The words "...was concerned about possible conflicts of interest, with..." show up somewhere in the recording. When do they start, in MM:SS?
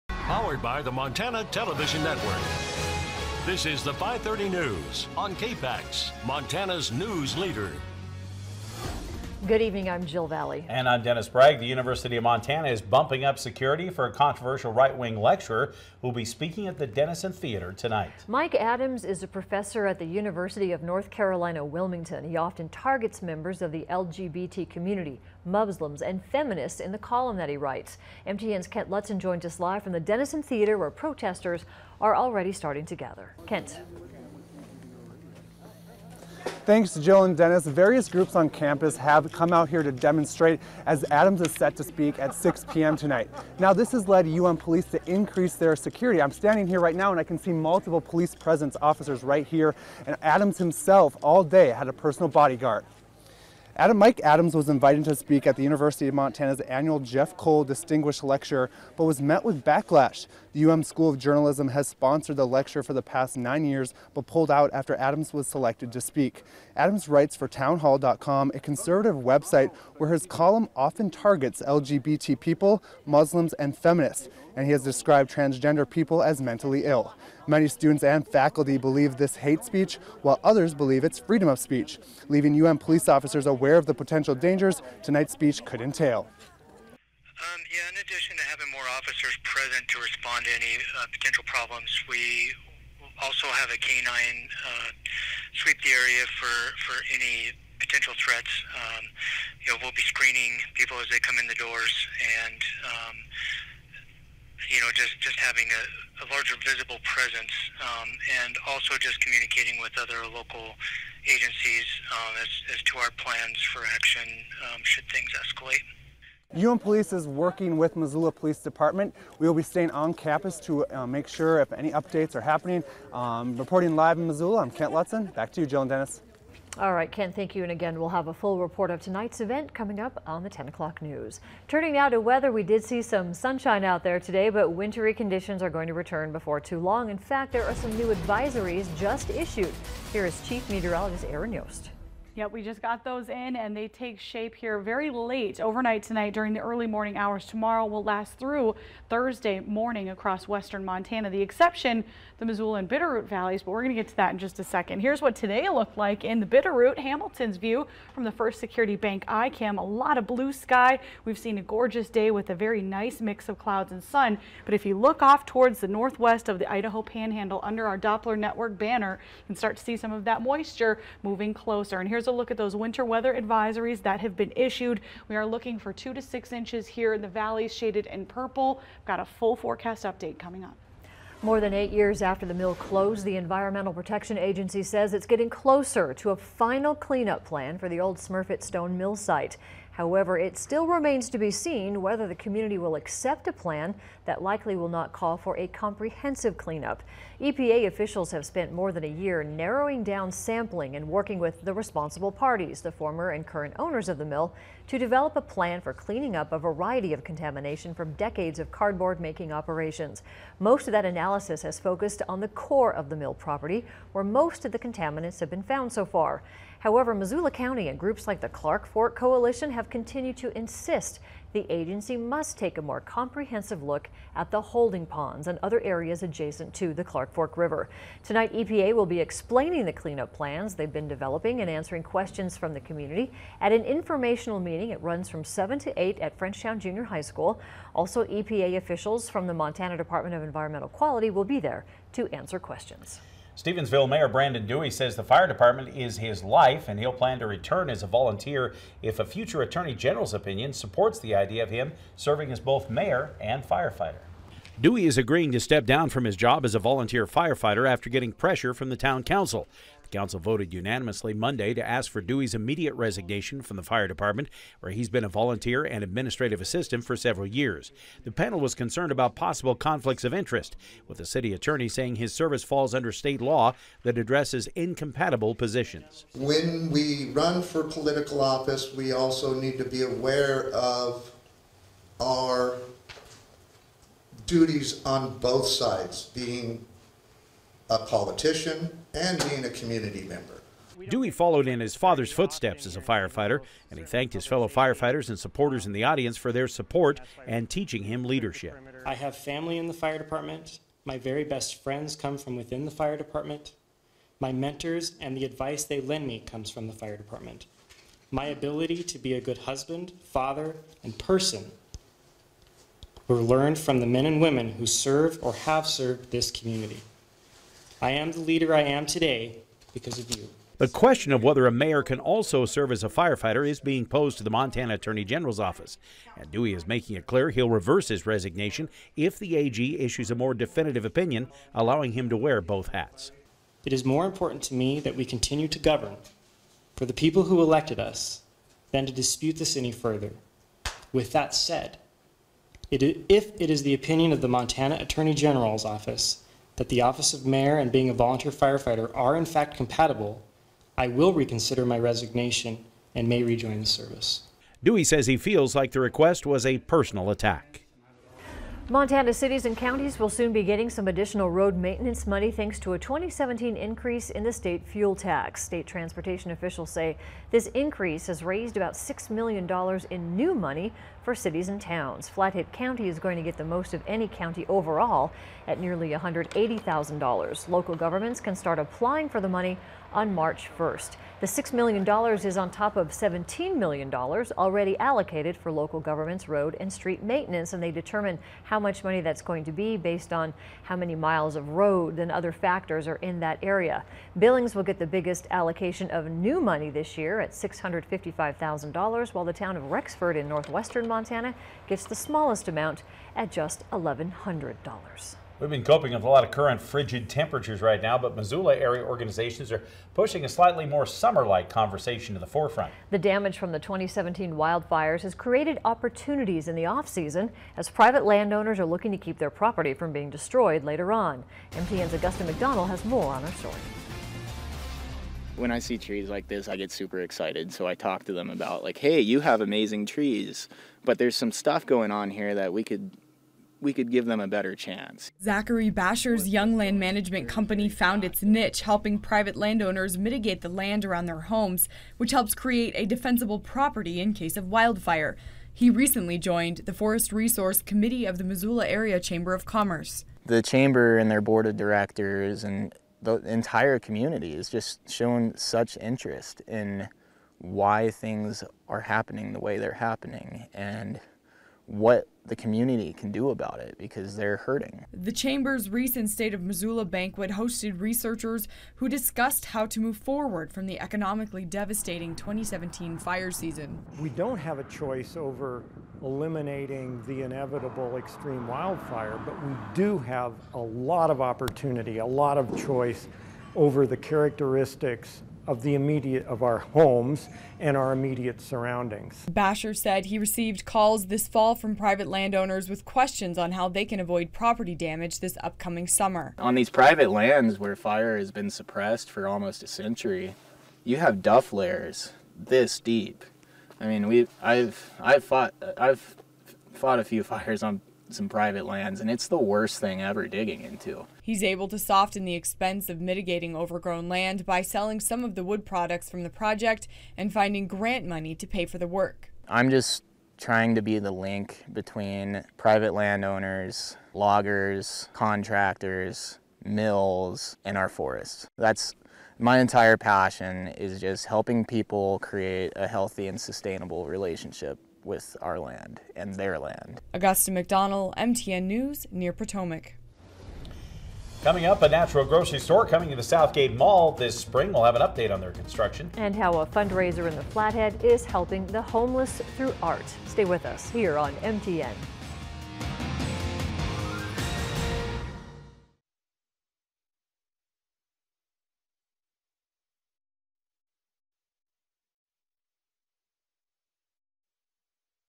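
04:28.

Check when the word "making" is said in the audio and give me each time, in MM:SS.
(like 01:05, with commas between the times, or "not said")
03:29, 05:26.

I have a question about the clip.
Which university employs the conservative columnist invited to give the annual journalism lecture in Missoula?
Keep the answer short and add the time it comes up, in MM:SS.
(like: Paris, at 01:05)
University of North Carolina, Wilmington, at 00:20.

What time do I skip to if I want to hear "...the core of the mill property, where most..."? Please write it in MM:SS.
03:32.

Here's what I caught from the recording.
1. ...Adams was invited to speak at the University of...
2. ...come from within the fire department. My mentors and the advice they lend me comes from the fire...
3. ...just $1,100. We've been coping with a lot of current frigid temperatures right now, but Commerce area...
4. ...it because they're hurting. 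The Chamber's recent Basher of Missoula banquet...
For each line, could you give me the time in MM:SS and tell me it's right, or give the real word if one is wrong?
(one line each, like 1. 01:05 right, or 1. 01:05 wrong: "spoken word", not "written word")
1. 00:54 right
2. 05:02 right
3. 06:43 wrong: "Missoula", not "Commerce"
4. 07:43 wrong: "State", not "Basher".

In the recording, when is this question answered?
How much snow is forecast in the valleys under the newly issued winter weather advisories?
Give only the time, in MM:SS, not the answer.
02:55.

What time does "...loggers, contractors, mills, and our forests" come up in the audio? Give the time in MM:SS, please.
08:44.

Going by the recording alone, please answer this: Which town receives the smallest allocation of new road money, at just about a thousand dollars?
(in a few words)
Rexford.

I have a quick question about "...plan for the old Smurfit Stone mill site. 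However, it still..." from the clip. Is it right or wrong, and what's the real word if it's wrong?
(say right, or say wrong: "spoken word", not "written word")
right.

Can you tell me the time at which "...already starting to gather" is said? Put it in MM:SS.
00:32.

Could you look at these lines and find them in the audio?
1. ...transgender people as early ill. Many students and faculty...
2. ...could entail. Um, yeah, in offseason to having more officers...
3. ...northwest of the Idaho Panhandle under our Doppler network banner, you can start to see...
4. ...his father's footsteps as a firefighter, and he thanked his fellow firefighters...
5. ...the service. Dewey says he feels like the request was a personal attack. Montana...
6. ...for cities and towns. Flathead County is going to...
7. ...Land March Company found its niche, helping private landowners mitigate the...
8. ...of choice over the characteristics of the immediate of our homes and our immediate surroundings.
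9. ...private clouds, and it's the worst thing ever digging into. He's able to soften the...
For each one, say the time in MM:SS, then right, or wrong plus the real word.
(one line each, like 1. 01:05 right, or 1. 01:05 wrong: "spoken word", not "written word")
1. 01:15 wrong: "mentally", not "early"
2. 01:25 wrong: "addition", not "offseason"
3. 02:45 right
4. 04:51 right
5. 05:53 right
6. 06:11 right
7. 07:16 wrong: "Management", not "March"
8. 08:02 right
9. 08:28 wrong: "lands", not "clouds".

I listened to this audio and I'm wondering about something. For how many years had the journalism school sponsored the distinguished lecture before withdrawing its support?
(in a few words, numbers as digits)
9.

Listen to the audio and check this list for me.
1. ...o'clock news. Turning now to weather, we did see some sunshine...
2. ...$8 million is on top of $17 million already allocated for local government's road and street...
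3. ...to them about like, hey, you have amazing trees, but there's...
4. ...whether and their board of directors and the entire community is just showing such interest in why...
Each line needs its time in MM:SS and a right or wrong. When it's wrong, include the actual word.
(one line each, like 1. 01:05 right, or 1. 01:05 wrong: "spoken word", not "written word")
1. 02:10 right
2. 06:21 wrong: "6", not "8"
3. 07:08 right
4. 07:30 wrong: "chamber", not "whether".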